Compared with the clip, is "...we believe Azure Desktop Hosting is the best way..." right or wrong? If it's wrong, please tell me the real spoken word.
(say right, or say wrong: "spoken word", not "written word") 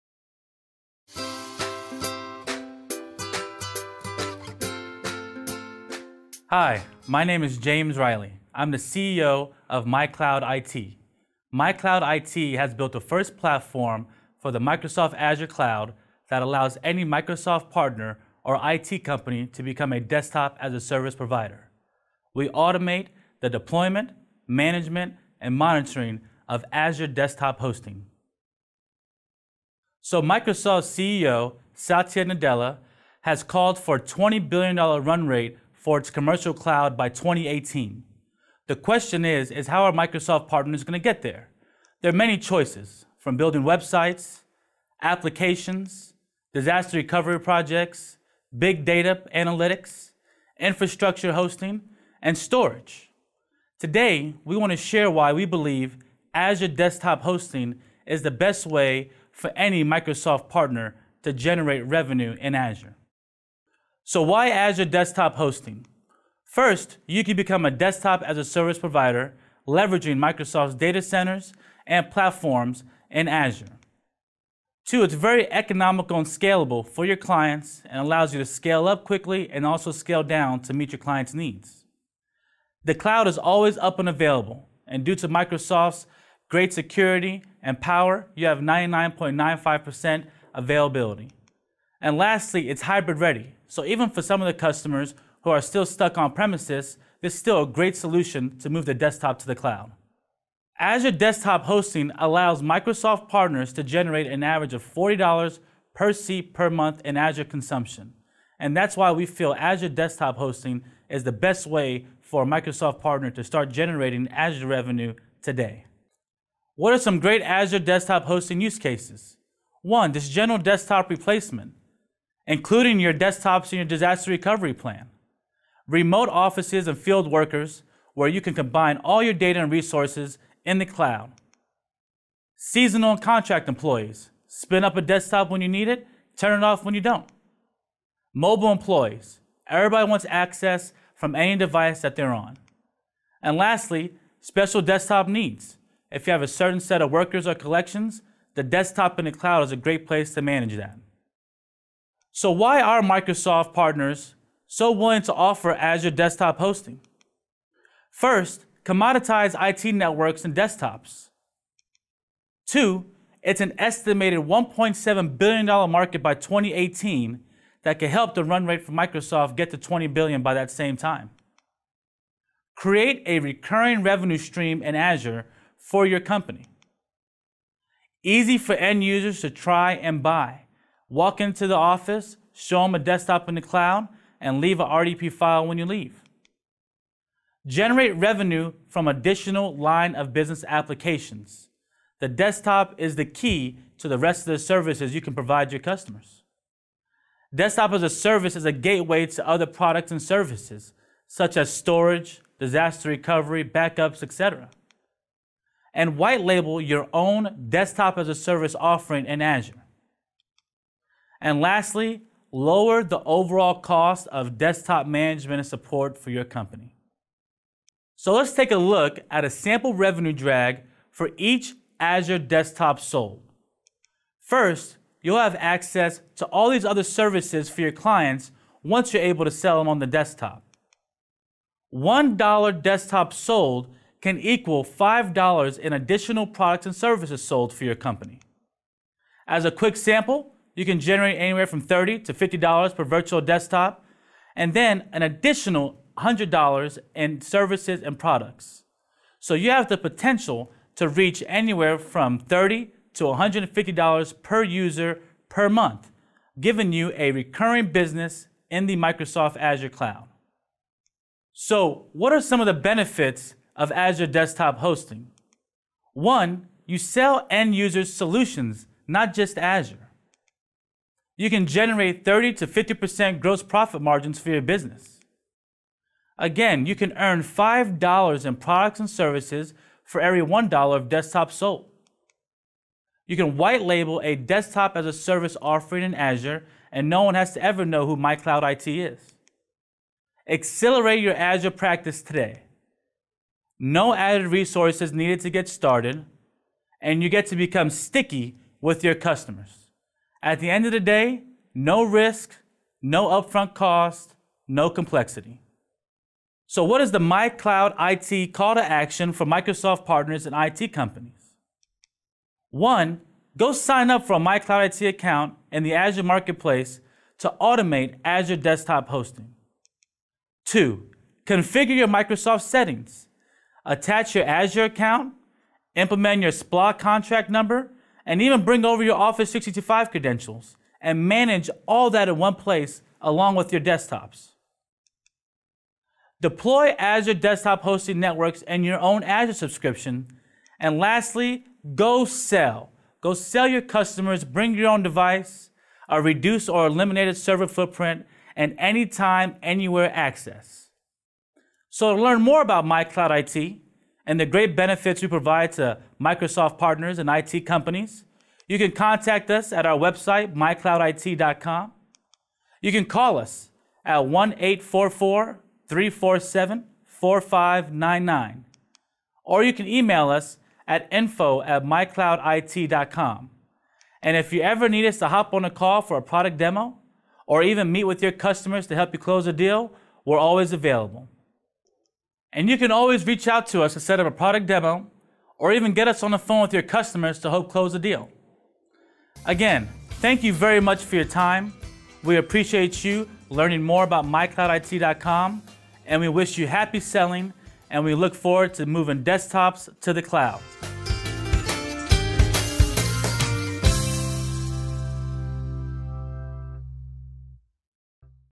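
right.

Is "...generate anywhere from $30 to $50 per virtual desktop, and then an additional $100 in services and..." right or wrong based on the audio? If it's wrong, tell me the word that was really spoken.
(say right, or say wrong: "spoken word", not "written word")
right.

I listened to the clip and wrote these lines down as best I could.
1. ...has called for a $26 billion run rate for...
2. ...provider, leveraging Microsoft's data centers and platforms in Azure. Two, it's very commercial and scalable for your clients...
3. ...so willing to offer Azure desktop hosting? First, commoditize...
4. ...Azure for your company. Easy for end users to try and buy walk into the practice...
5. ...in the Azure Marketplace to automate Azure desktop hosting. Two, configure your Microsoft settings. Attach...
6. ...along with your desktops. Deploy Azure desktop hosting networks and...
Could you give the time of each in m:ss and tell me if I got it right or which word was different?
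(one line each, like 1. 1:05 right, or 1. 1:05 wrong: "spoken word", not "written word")
1. 0:33 wrong: "20", not "26"
2. 1:08 wrong: "economical", not "commercial"
3. 2:34 right
4. 2:54 wrong: "office", not "practice"
5. 5:15 right
6. 5:33 right.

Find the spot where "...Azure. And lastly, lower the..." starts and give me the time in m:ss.
3:29.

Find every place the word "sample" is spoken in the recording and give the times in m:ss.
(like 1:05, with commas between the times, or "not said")
3:39, 3:59.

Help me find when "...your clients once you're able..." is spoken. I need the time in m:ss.
3:47.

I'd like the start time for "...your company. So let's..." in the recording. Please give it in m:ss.
3:36.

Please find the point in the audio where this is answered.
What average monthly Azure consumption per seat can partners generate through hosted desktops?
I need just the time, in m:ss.
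1:44.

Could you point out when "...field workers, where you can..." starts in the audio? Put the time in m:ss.
2:06.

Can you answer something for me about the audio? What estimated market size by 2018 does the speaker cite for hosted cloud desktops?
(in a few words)
$1.7 billion.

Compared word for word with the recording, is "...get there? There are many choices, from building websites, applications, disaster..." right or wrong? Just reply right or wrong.
right.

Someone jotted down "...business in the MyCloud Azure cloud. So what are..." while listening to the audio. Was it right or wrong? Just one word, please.
wrong.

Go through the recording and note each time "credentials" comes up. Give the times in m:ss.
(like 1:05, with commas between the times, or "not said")
5:30.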